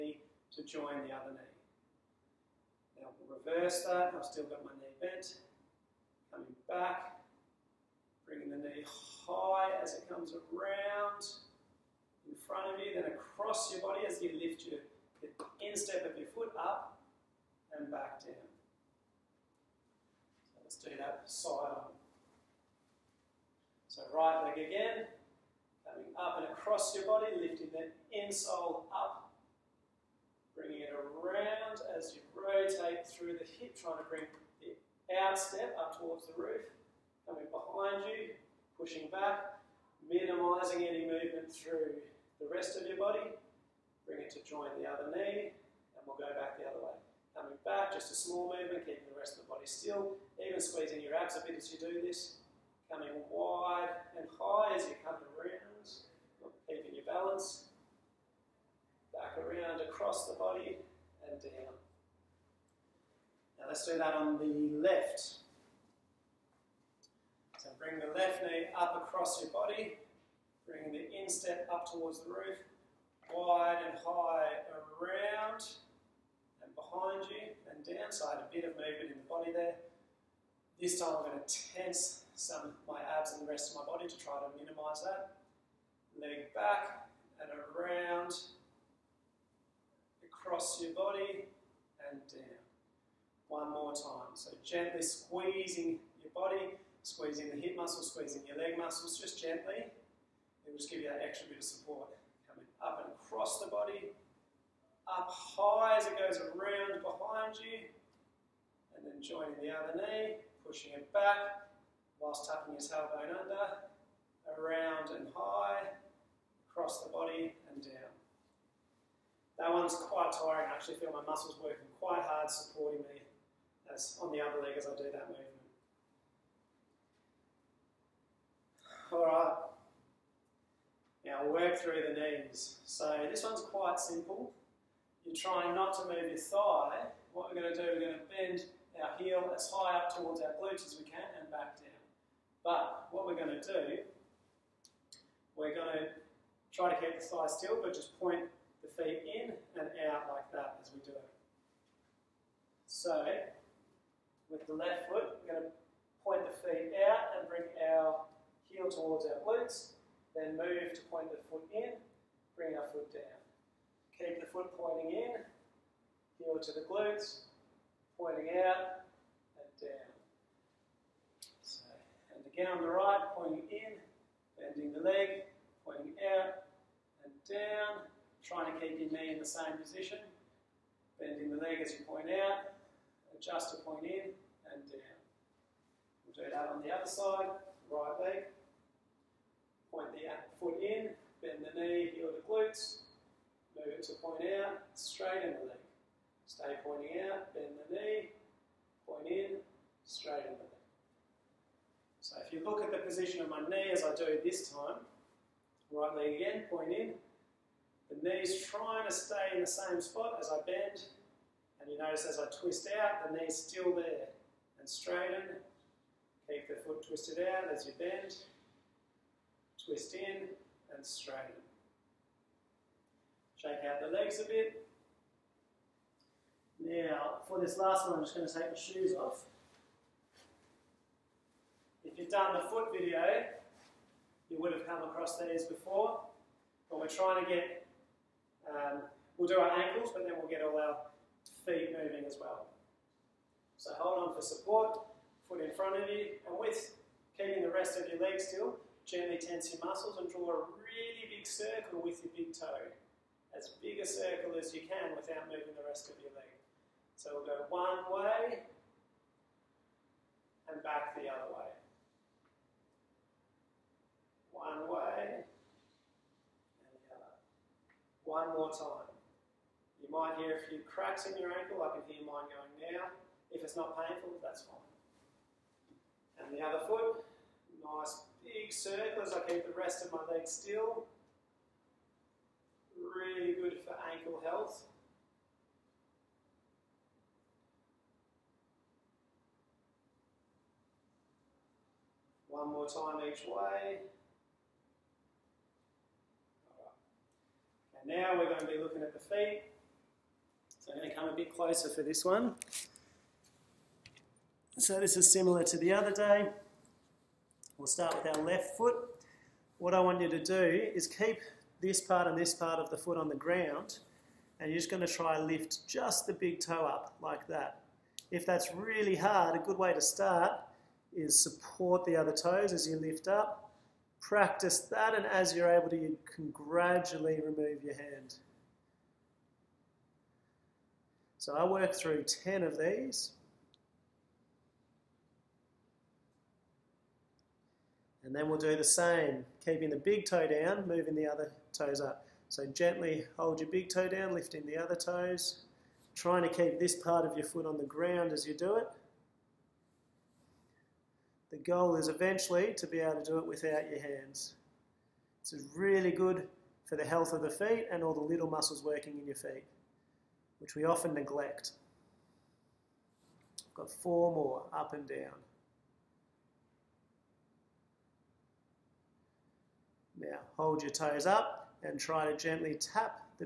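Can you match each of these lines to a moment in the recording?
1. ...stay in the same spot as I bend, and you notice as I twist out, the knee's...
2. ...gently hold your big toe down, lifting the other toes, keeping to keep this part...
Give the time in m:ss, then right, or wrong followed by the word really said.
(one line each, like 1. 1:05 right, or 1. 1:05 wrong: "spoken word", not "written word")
1. 3:29 right
2. 5:42 wrong: "trying", not "keeping".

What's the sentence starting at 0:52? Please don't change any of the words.
Coming wide and high as you come around, keeping your balance.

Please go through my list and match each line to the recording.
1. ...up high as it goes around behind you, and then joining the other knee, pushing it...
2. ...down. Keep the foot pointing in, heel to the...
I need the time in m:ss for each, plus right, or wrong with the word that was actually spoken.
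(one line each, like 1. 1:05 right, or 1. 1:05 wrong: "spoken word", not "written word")
1. 1:45 right
2. 2:43 right.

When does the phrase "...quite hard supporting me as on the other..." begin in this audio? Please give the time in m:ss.
2:02.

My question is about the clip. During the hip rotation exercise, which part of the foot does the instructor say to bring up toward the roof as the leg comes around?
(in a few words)
outstep.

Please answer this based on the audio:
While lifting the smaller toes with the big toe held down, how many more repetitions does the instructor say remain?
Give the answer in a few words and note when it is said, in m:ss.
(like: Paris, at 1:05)
4, at 6:03.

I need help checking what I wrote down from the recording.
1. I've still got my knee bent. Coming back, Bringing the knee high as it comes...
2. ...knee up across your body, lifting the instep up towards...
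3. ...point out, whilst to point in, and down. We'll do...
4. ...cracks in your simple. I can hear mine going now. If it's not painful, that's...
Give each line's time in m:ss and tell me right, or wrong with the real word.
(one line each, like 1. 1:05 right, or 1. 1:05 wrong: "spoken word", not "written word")
1. 0:04 right
2. 1:08 wrong: "bring", not "lifting"
3. 3:02 wrong: "adjust", not "whilst"
4. 4:30 wrong: "ankle", not "simple".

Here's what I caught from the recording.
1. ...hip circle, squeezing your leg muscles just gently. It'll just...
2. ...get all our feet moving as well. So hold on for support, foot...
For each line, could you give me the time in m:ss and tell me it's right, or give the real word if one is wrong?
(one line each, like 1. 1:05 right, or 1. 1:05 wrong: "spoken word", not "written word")
1. 1:37 wrong: "muscle", not "circle"
2. 4:00 right.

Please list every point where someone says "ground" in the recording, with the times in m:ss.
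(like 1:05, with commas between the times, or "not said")
5:13, 5:47.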